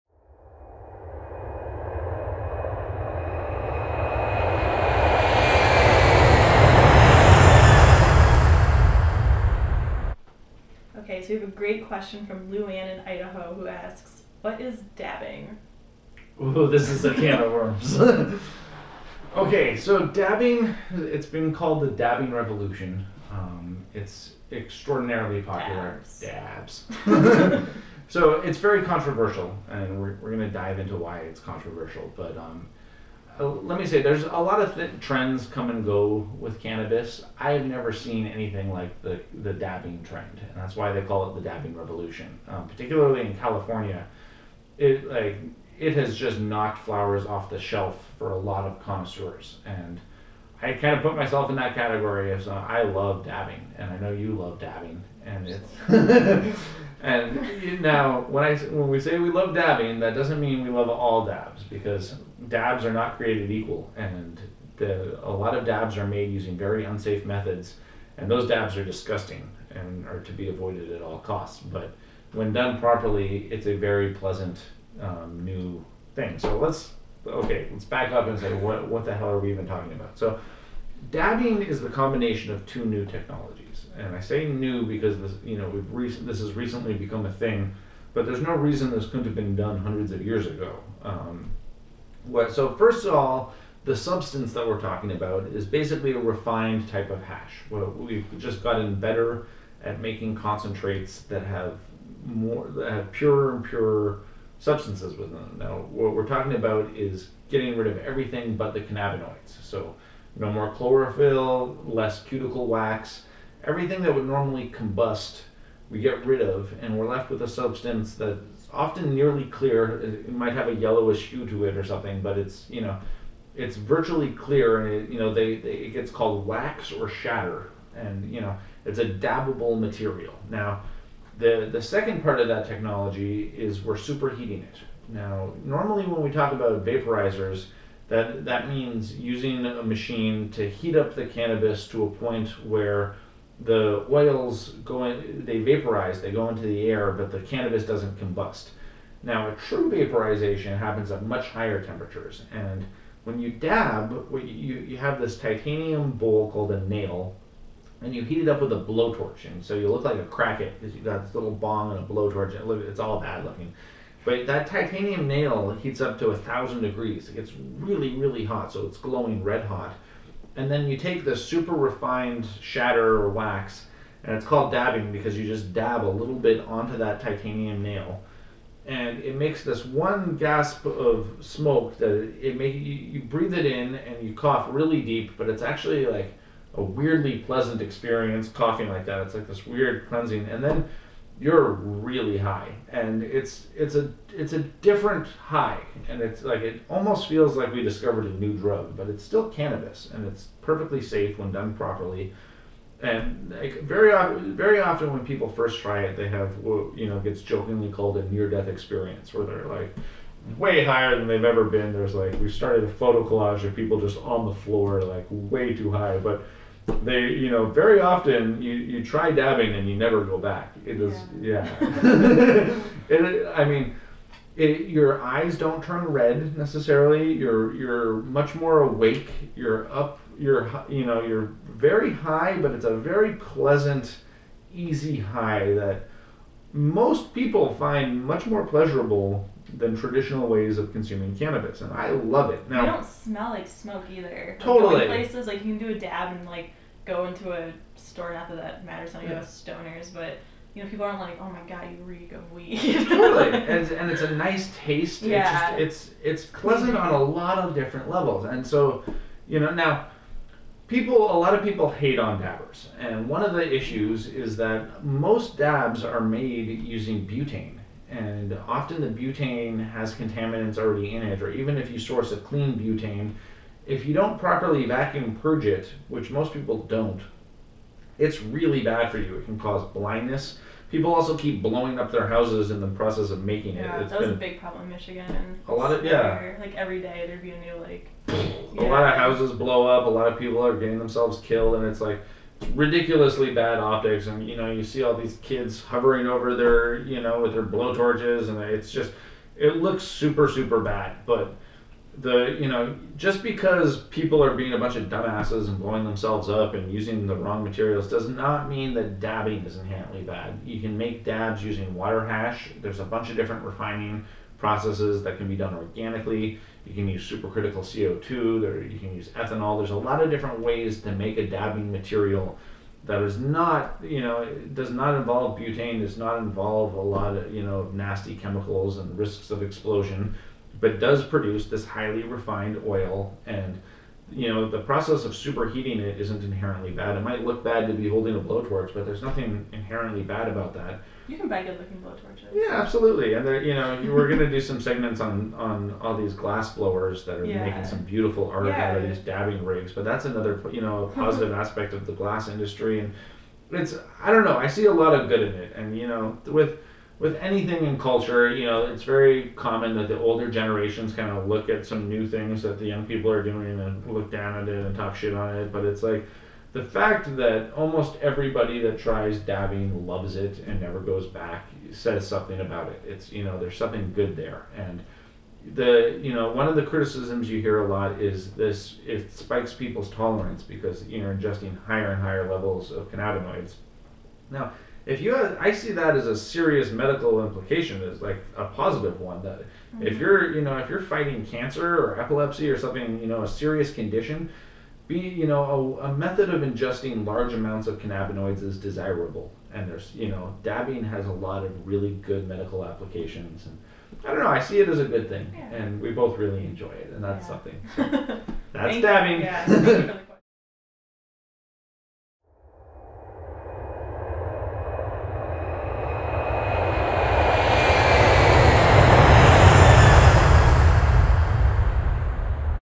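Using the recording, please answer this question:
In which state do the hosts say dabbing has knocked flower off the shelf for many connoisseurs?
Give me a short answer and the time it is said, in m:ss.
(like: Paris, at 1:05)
California, at 0:43.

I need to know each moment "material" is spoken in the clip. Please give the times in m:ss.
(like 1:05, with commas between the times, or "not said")
2:09, 5:07, 5:21.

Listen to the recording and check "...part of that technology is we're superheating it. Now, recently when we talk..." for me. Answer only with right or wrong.
wrong.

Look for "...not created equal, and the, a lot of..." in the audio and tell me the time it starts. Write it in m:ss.
1:02.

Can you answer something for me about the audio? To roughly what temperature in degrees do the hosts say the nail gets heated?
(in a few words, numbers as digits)
1000 degrees.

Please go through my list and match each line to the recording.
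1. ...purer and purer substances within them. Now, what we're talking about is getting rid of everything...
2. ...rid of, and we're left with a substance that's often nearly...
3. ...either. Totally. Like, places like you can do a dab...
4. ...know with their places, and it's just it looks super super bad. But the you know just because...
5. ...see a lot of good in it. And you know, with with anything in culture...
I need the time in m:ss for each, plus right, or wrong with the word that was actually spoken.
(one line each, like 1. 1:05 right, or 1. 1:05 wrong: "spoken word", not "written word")
1. 1:43 right
2. 1:56 right
3. 4:04 right
4. 4:57 wrong: "blowtorches", not "places"
5. 5:54 right.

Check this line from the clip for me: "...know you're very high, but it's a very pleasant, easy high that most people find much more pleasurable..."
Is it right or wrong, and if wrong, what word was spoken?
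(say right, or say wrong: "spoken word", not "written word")
right.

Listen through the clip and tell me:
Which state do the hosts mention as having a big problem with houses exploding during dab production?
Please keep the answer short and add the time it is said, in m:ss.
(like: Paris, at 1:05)
Michigan, at 4:44.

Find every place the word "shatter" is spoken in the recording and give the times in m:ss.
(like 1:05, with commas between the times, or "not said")
2:07, 2:52.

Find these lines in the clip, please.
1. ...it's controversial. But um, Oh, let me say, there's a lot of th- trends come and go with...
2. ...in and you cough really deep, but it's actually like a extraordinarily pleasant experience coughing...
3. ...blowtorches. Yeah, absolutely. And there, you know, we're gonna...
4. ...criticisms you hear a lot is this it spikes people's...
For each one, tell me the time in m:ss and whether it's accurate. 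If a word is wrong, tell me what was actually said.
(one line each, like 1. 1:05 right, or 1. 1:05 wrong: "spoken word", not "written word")
1. 0:31 right
2. 3:03 wrong: "weirdly", not "extraordinarily"
3. 5:42 right
4. 6:16 right.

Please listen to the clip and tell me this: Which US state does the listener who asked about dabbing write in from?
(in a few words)
Idaho.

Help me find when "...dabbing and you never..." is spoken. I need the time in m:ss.
3:39.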